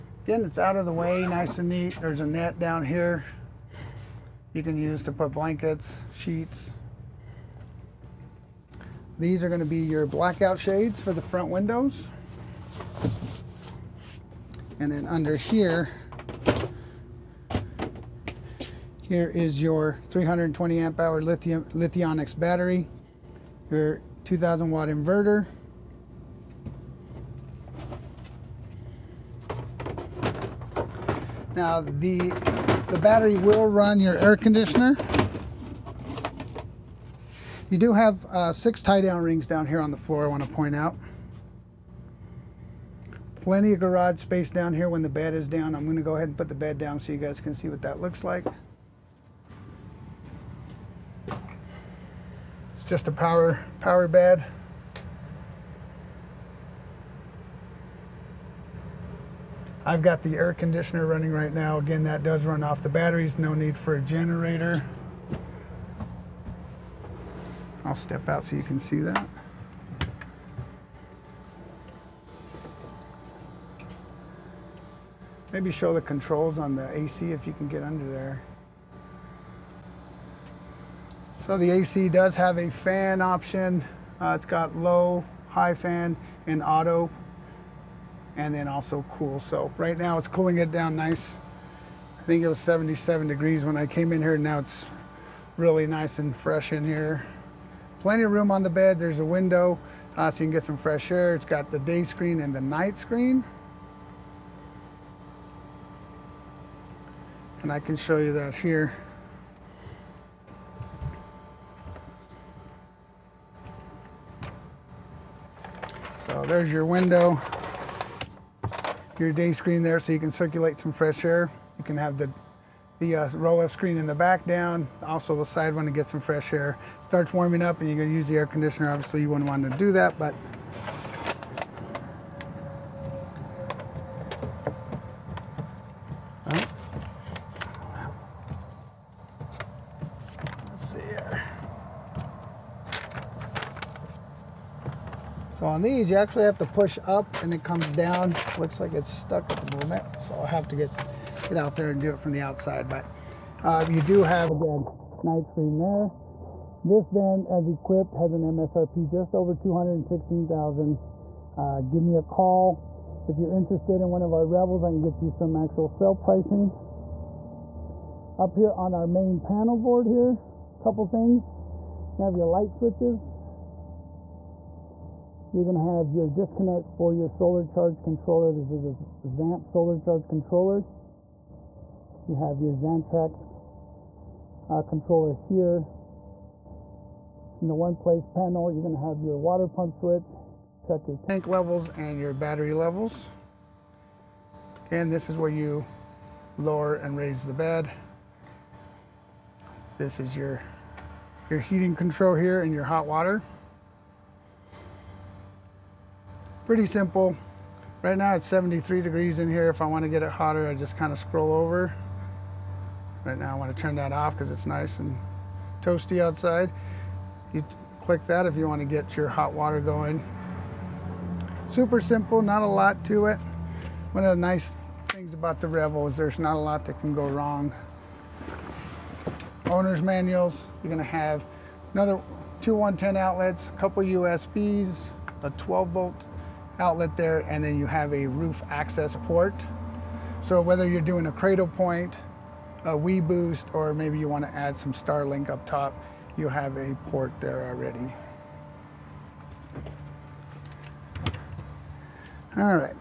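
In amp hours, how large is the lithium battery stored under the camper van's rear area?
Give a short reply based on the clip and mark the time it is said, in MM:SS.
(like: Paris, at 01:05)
320 amp hours, at 00:20.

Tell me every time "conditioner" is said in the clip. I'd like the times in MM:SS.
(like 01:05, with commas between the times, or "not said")
00:34, 01:00, 02:08.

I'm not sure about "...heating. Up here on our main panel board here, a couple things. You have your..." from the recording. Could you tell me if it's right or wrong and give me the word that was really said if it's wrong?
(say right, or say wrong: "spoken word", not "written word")
wrong: "pricing", not "heating".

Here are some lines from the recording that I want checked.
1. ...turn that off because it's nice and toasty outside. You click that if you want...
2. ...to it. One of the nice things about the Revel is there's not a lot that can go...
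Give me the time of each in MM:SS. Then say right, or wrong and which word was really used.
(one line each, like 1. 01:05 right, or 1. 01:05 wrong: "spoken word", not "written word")
1. 03:33 right
2. 03:43 right.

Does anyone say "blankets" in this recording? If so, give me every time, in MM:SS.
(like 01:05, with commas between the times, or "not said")
00:05.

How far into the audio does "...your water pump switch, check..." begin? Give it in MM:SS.
03:09.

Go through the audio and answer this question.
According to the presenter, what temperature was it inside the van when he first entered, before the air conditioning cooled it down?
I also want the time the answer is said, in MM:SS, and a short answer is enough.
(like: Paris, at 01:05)
77 degrees, at 01:32.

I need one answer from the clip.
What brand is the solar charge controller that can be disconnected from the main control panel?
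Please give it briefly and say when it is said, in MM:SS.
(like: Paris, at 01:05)
ZAMP, at 02:59.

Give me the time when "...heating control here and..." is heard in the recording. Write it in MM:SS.
03:21.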